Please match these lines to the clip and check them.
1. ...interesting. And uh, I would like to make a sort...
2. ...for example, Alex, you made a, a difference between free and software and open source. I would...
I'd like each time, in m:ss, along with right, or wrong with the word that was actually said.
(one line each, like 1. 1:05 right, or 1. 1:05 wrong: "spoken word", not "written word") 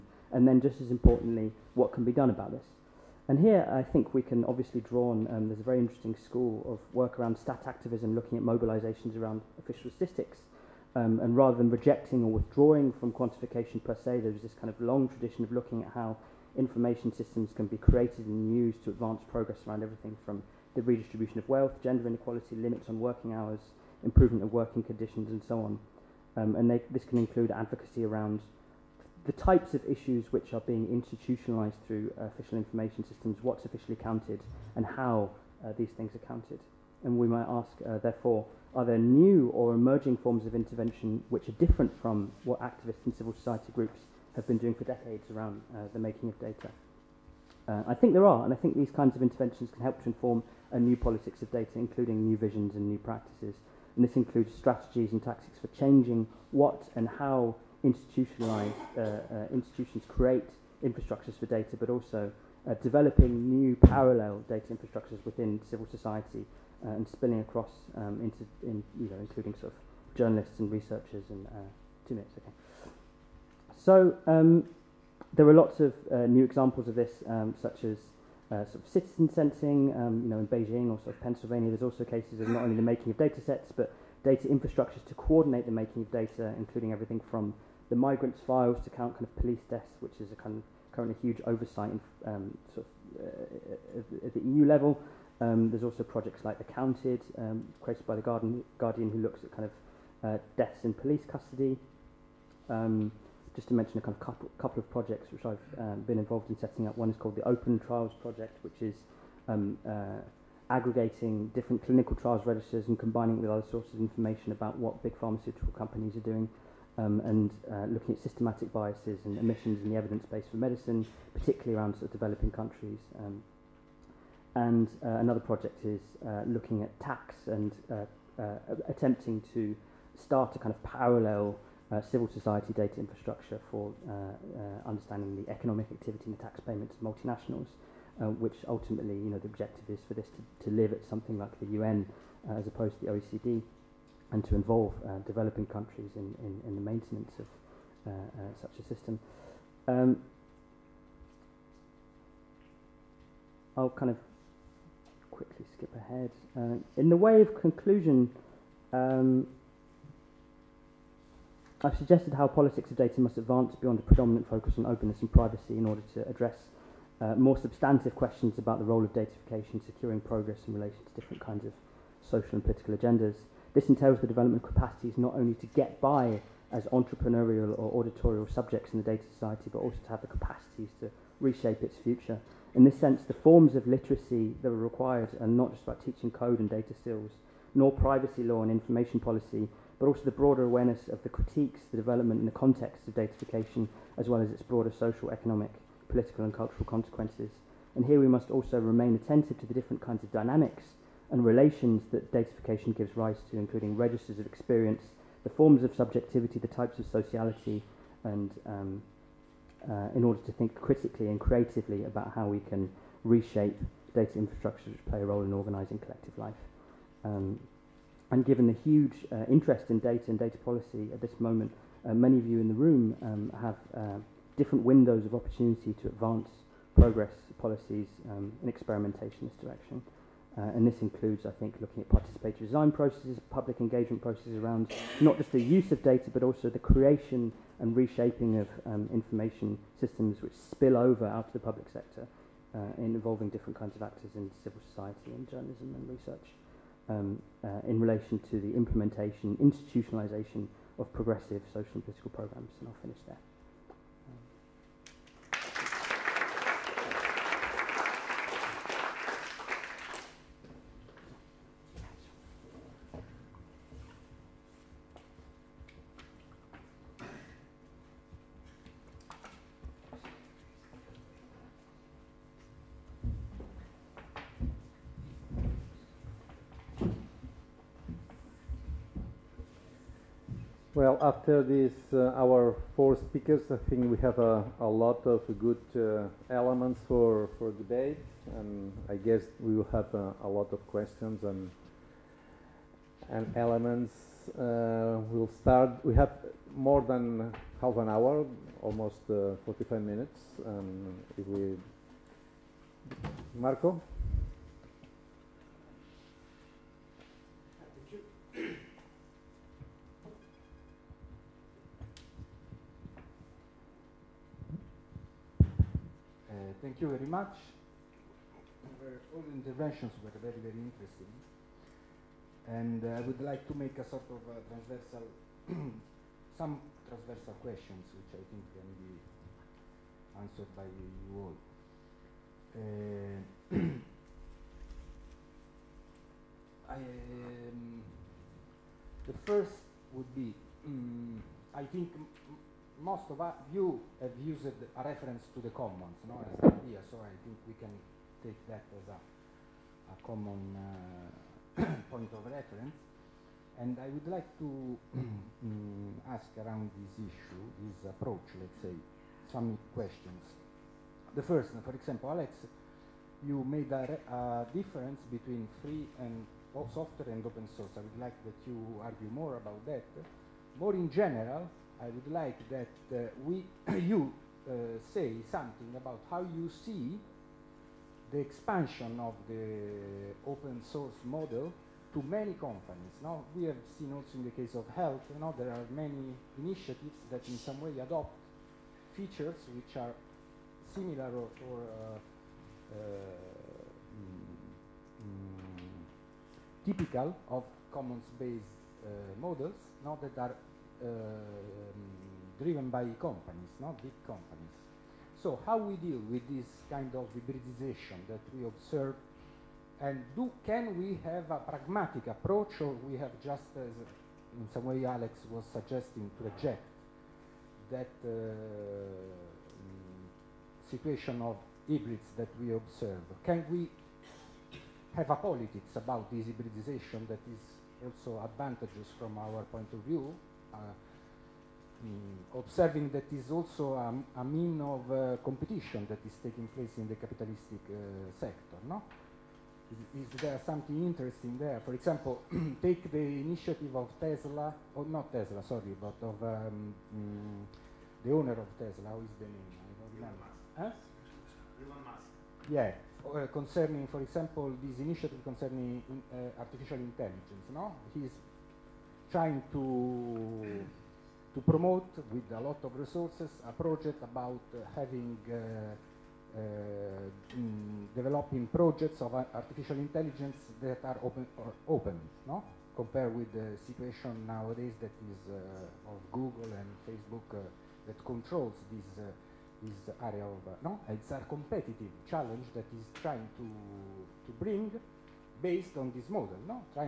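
1. 5:20 right
2. 6:01 right.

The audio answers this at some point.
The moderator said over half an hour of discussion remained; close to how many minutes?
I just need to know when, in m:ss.
4:59.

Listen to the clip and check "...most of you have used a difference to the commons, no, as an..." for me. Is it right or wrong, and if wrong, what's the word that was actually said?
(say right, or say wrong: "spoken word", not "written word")
wrong: "reference", not "difference".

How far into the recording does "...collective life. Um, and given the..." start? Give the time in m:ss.
3:35.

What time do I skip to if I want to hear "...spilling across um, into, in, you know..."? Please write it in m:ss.
1:07.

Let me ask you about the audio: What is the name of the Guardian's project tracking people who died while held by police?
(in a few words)
Accounted.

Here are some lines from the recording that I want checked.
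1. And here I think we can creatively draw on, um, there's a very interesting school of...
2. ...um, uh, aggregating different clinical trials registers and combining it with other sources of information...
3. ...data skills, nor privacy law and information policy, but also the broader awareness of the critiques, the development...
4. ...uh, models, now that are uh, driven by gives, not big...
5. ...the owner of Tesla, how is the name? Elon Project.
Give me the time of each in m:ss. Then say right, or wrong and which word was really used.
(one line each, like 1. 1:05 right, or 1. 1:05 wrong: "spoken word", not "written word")
1. 0:03 wrong: "obviously", not "creatively"
2. 1:49 right
3. 3:06 right
4. 6:39 wrong: "companies", not "gives"
5. 7:28 wrong: "Musk", not "Project".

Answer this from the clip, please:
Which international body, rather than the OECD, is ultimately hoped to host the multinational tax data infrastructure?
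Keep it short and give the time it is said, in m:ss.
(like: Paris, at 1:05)
the UN, at 2:21.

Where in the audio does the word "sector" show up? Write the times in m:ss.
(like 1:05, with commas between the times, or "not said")
4:01, 7:18.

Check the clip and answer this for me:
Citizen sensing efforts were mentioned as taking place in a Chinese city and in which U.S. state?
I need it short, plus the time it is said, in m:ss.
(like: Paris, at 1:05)
Pennsylvania, at 1:21.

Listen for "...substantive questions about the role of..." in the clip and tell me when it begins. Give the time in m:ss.
2:47.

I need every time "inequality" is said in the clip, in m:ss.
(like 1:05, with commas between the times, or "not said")
0:22.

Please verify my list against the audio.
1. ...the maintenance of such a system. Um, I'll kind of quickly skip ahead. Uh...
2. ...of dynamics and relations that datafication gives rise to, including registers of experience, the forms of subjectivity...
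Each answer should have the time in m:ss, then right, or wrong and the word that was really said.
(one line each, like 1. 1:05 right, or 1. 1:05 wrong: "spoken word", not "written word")
1. 2:26 right
2. 3:20 right.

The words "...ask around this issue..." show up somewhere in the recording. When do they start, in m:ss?
5:56.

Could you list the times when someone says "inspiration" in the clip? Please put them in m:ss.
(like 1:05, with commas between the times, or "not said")
not said.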